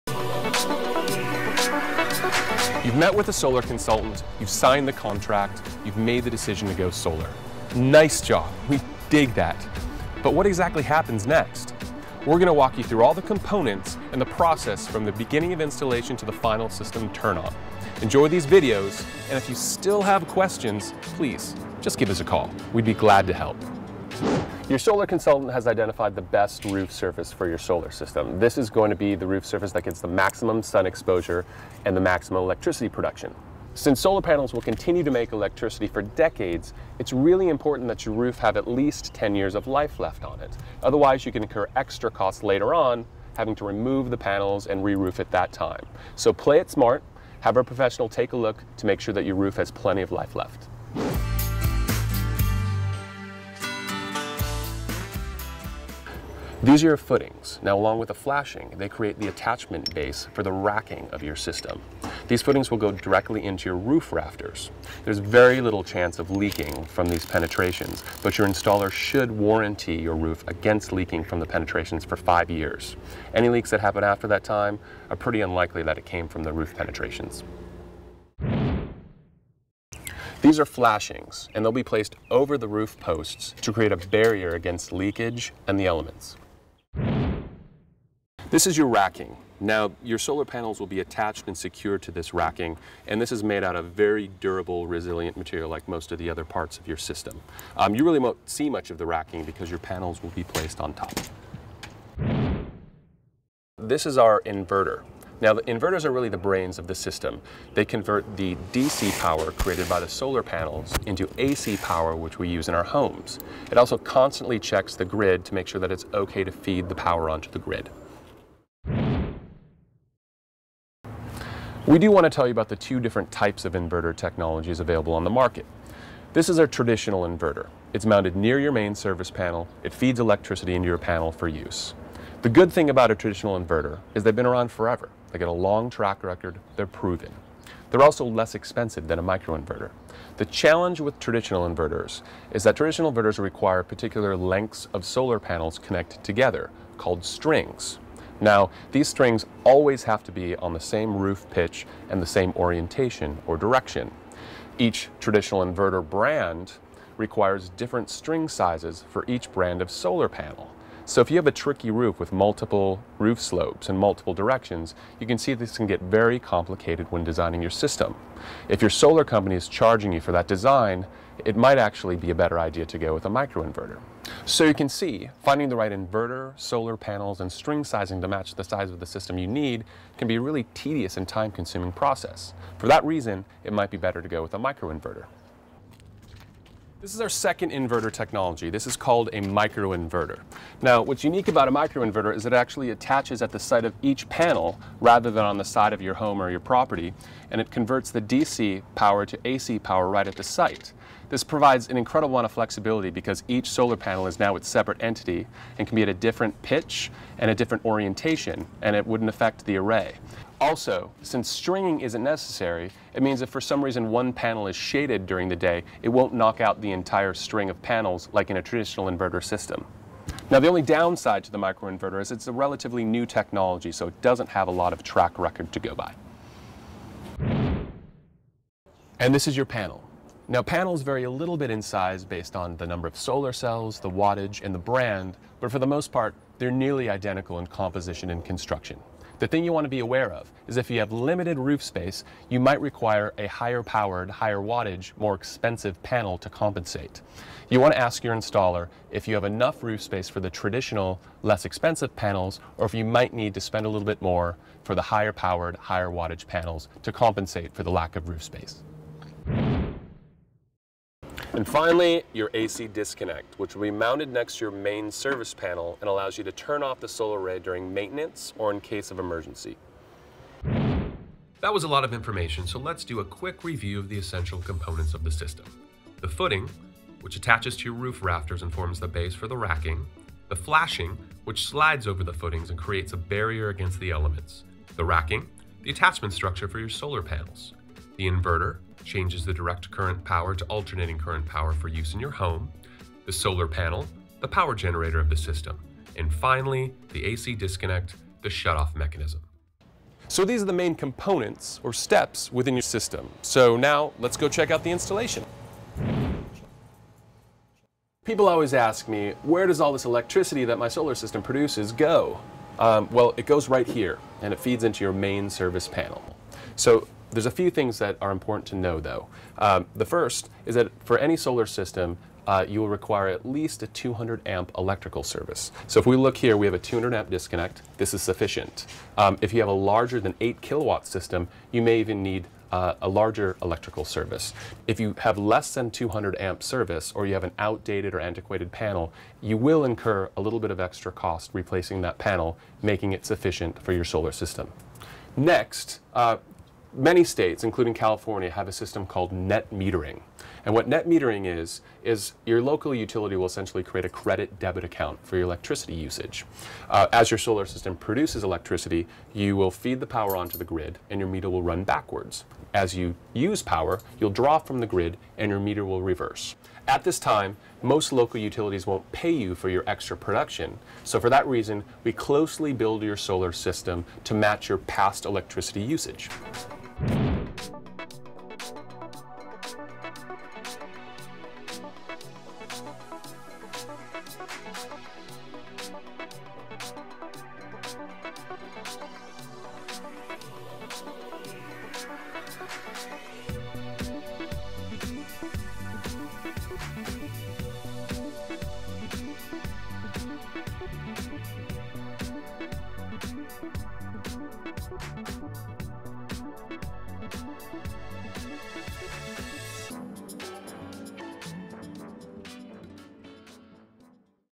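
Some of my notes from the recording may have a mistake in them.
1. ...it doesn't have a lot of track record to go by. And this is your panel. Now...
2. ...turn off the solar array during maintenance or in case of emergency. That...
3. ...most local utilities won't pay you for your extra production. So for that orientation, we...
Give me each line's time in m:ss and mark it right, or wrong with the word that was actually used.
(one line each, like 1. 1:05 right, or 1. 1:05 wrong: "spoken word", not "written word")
1. 3:44 right
2. 4:26 right
3. 6:07 wrong: "reason", not "orientation".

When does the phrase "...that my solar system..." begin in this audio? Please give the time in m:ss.
5:10.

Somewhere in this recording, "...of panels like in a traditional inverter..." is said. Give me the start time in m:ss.
3:37.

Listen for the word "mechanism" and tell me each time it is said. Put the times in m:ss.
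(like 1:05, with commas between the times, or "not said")
4:58.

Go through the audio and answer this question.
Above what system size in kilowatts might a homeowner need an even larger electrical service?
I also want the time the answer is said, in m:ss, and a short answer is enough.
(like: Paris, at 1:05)
8 kilowatts, at 5:30.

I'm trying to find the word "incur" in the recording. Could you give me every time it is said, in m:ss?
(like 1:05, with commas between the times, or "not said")
0:41, 5:39.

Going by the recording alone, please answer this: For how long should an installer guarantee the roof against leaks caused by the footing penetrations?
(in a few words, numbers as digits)
5 years.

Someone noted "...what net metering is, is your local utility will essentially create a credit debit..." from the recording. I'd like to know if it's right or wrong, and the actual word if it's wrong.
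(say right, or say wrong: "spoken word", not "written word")
right.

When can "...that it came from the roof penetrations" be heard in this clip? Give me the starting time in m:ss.
1:15.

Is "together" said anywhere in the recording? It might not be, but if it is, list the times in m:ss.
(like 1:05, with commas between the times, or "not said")
2:26.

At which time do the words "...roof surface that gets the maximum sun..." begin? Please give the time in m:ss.
0:29.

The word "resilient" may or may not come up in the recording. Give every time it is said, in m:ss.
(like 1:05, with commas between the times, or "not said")
1:34.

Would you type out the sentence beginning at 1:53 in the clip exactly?
It also constantly checks the grid to make sure that it's okay to feed the power onto the grid.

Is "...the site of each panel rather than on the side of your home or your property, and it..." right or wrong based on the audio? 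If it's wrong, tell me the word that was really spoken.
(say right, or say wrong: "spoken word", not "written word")
right.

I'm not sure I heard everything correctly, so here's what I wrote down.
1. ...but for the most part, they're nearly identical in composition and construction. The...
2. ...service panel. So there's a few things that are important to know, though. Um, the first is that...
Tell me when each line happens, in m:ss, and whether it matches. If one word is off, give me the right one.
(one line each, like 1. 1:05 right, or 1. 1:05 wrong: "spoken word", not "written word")
1. 3:55 right
2. 5:15 right.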